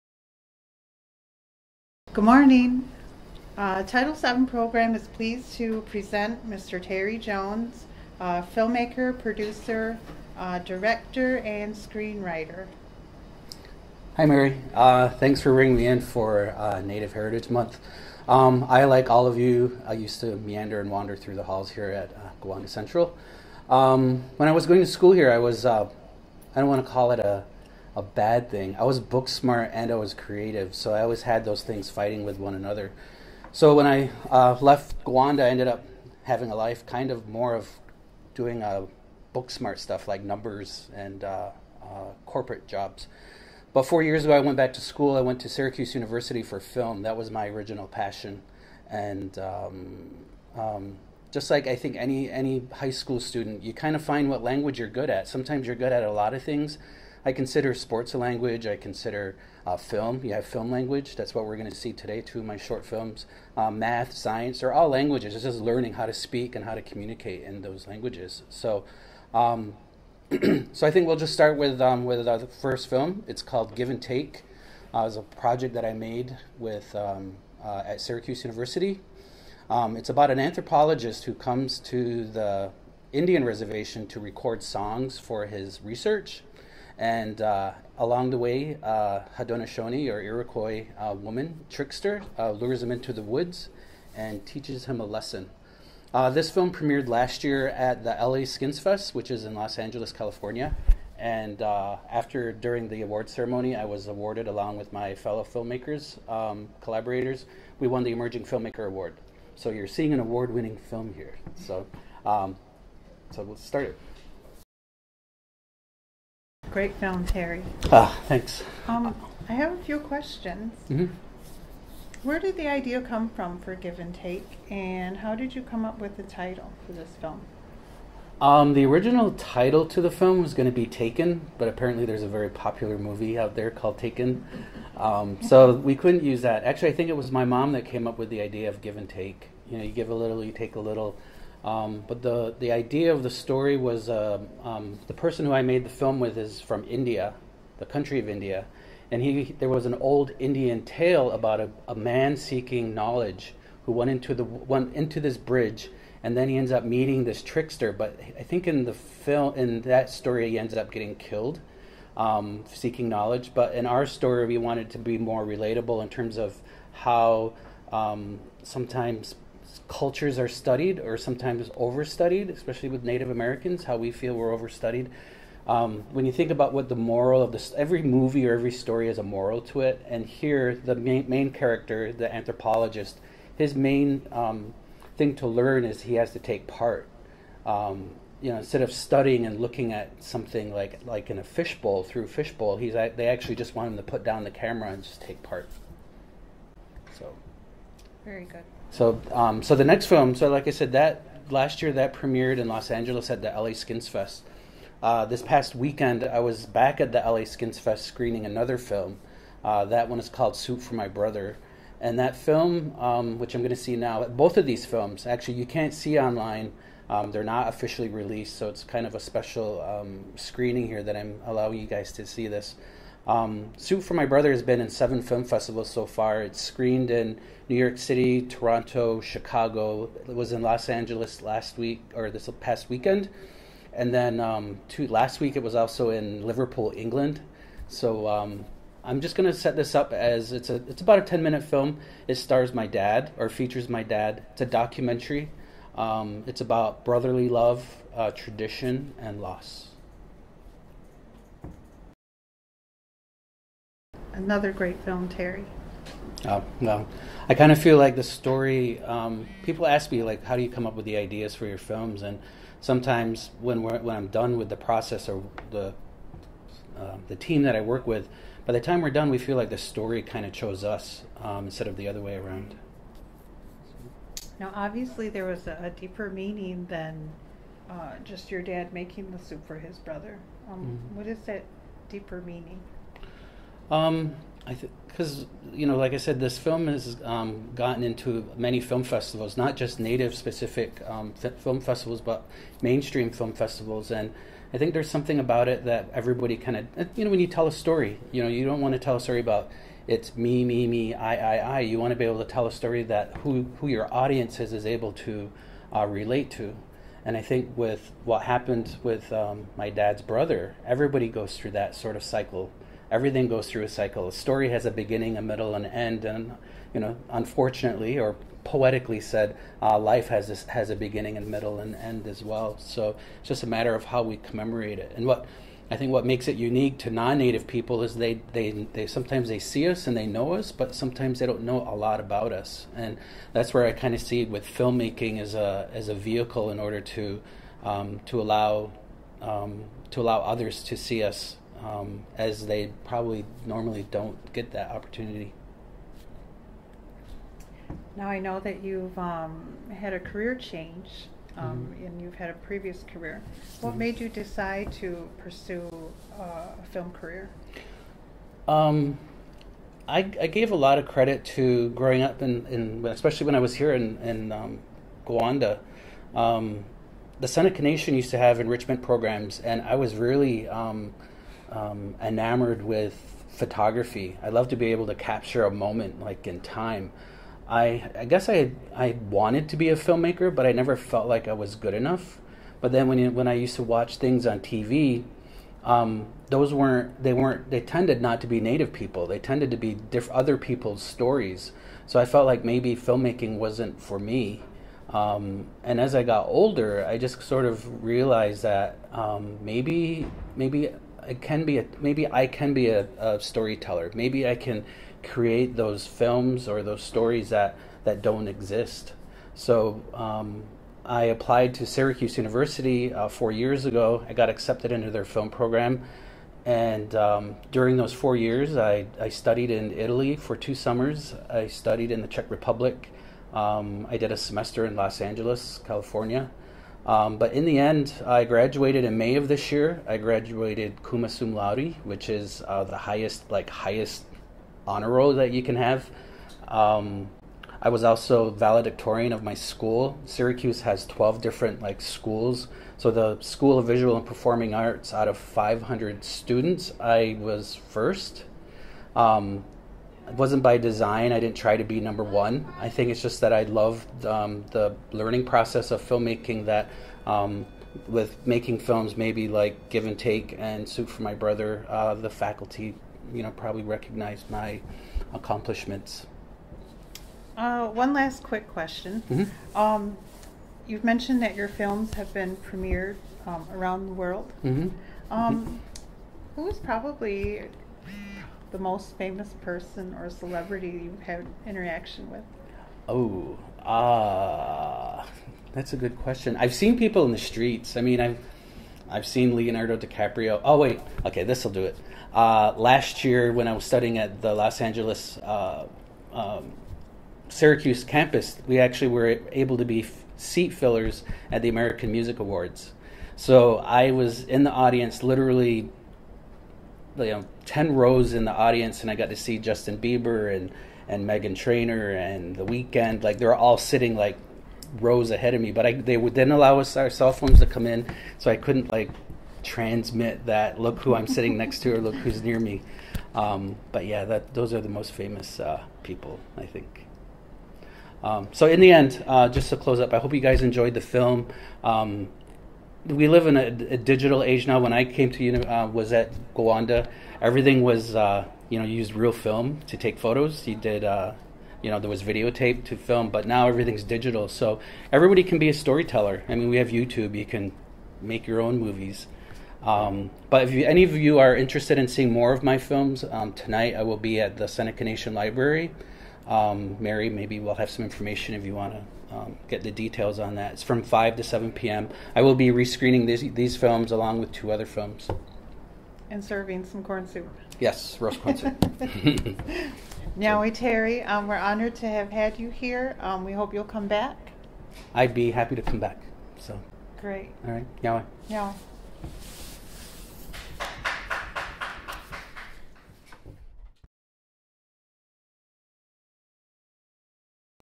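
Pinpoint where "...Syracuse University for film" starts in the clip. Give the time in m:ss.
0:45.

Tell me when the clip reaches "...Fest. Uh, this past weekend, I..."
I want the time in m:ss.
3:24.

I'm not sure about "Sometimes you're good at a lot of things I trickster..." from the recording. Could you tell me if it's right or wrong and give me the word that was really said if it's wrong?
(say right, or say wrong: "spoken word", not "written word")
wrong: "consider", not "trickster".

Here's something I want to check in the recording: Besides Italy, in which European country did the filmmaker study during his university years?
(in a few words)
Czech Republic.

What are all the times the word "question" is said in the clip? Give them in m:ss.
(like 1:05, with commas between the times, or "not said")
1:59, 7:48, 8:06.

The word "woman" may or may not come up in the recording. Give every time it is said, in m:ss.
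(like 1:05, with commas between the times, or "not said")
1:31.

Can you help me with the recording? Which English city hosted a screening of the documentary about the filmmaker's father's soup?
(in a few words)
Liverpool.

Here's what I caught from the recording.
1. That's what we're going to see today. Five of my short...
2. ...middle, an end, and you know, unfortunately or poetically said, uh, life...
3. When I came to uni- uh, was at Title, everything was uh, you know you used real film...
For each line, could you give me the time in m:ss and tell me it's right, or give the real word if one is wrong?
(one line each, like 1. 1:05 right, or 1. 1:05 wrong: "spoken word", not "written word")
1. 1:01 wrong: "Two", not "Five"
2. 5:15 right
3. 8:54 wrong: "Gowanda", not "Title".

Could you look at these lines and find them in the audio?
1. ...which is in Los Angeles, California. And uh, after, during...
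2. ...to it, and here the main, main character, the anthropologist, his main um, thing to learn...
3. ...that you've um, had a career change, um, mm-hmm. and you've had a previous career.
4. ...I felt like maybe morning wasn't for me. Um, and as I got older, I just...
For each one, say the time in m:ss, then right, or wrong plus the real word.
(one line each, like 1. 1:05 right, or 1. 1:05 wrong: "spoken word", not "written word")
1. 1:39 right
2. 2:59 right
3. 5:48 right
4. 6:32 wrong: "filmmaking", not "morning".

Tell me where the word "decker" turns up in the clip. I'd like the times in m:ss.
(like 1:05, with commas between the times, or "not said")
not said.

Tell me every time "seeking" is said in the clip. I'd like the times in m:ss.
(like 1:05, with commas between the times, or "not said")
2:32, 2:42.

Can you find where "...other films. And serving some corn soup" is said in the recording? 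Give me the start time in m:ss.
9:24.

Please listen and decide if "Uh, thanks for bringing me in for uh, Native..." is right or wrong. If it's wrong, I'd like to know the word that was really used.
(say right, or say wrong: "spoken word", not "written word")
right.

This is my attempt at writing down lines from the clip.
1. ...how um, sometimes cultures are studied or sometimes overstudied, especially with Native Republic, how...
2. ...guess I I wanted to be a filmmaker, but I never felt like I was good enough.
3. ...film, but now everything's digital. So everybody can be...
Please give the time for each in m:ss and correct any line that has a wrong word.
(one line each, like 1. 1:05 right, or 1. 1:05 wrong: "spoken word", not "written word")
1. 2:46 wrong: "Americans", not "Republic"
2. 6:18 right
3. 9:02 right.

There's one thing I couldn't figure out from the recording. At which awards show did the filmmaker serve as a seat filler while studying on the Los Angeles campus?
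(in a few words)
American Music Awards.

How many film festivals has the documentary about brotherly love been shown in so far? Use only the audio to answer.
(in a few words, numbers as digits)
7.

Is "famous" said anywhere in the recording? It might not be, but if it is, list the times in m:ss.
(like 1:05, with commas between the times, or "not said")
7:59, 8:45.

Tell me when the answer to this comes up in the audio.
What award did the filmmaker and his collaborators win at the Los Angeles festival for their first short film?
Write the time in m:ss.
1:48.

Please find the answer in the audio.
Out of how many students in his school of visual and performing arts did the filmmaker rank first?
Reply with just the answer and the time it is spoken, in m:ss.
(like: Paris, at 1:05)
500, at 7:25.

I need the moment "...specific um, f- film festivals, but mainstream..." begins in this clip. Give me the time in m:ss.
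4:50.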